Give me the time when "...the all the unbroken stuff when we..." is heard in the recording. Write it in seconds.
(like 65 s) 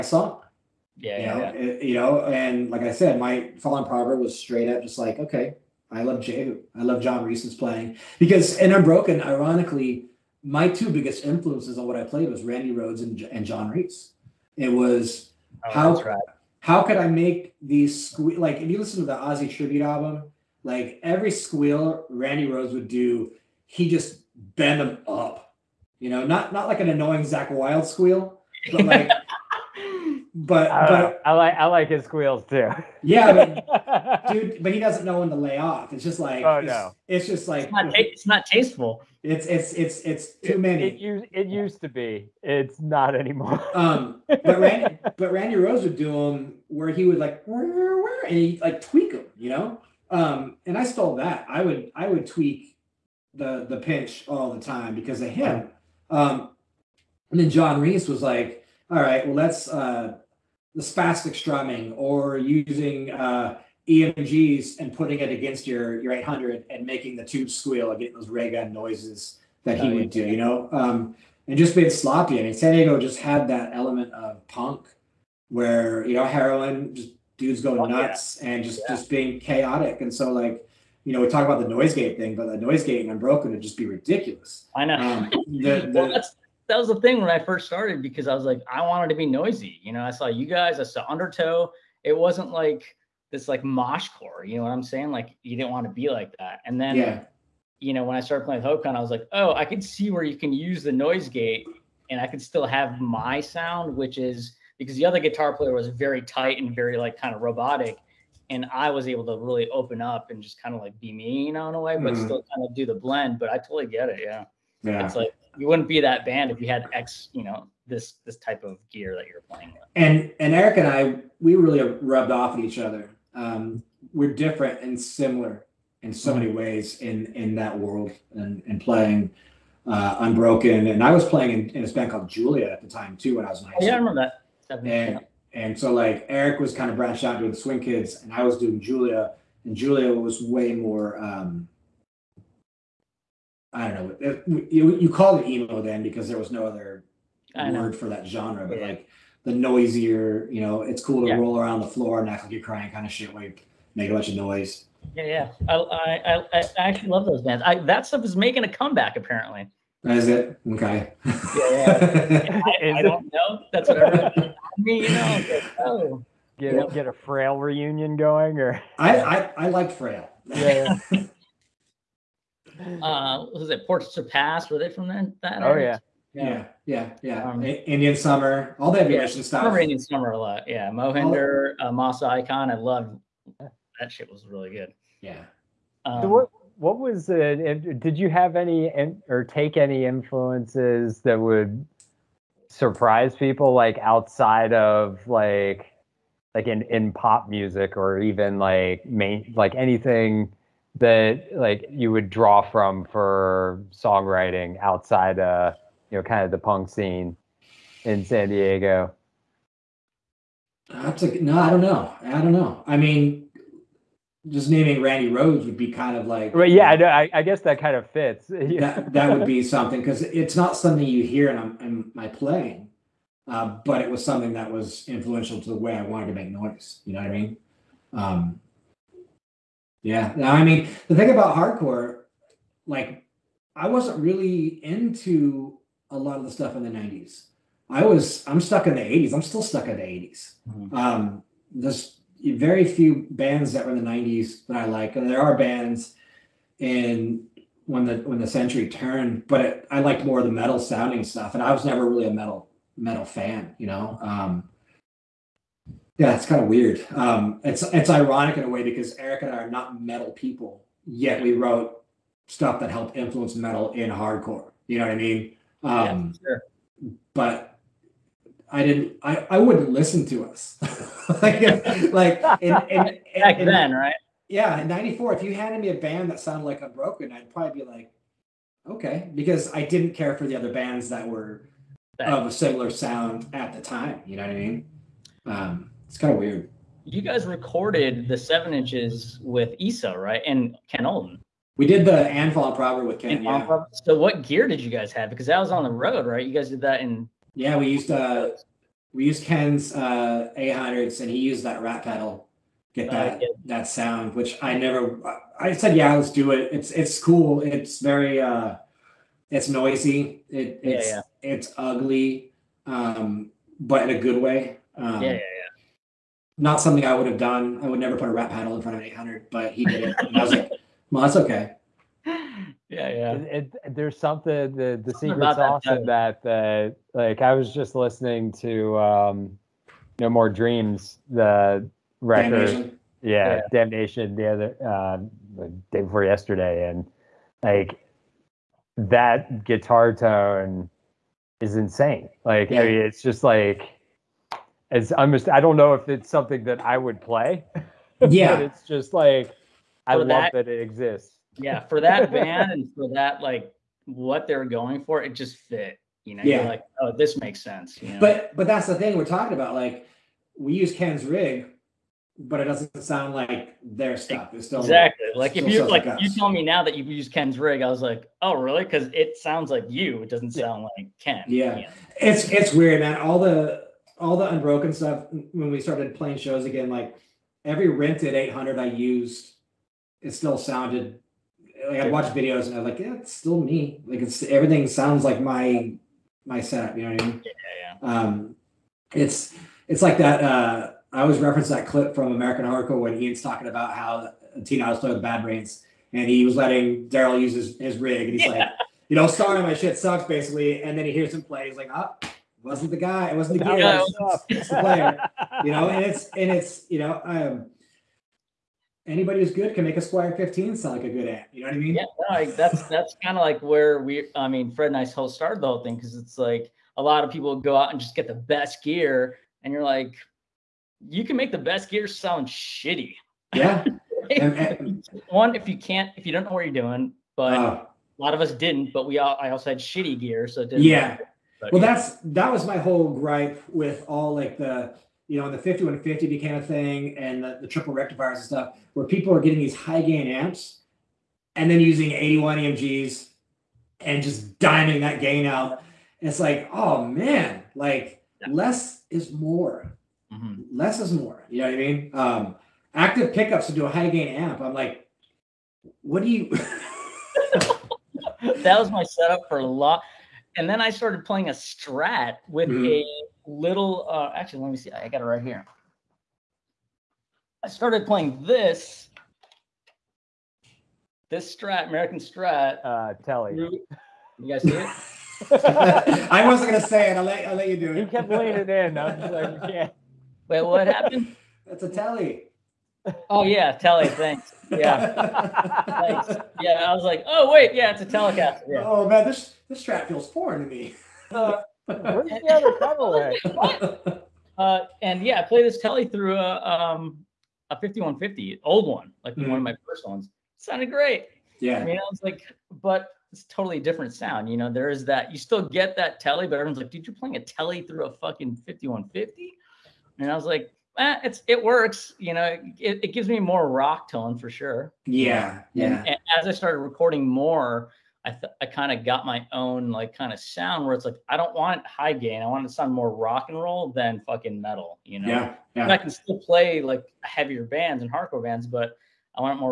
373 s.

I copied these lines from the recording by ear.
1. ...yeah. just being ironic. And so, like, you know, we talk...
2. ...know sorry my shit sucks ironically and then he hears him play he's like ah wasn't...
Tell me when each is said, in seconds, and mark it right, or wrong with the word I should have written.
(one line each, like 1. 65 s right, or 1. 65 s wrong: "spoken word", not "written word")
1. 78 s wrong: "chaotic", not "ironic"
2. 399 s wrong: "basically", not "ironically".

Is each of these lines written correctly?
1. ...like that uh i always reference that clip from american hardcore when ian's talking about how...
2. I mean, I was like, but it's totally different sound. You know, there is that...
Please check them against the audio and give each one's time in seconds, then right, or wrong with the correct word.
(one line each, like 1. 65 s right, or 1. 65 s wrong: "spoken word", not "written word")
1. 390 s right
2. 501 s right.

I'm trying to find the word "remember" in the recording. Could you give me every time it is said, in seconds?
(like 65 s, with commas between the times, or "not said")
133 s, 179 s.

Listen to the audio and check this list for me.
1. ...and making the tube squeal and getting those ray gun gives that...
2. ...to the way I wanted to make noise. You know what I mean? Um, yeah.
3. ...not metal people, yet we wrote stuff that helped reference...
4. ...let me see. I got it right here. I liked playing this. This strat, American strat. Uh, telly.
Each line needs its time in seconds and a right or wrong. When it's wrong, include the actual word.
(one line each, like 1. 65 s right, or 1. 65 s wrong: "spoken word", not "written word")
1. 66 s wrong: "noises", not "gives"
2. 225 s right
3. 259 s wrong: "influence", not "reference"
4. 464 s wrong: "started", not "liked".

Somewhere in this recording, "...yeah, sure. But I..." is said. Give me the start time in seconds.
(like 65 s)
266 s.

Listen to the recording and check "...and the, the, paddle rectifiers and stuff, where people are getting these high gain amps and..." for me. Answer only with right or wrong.
wrong.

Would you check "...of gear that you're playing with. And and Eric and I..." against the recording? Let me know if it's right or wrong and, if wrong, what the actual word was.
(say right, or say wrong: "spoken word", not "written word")
right.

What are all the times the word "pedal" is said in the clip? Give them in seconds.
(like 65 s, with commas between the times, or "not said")
302 s, 492 s.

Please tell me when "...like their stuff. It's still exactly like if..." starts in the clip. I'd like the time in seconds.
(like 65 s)
363 s.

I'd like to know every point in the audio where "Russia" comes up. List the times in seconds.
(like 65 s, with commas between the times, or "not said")
not said.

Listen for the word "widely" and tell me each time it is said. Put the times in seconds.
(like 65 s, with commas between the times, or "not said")
not said.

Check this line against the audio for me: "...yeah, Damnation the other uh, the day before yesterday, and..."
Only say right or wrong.
right.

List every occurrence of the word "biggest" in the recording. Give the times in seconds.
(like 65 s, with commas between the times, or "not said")
10 s.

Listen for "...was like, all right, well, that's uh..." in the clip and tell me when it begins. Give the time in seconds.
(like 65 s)
58 s.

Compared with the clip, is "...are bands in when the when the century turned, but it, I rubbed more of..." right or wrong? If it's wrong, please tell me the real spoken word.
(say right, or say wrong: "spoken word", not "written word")
wrong: "liked", not "rubbed".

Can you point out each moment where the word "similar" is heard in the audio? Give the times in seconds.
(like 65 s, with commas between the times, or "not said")
124 s, 282 s.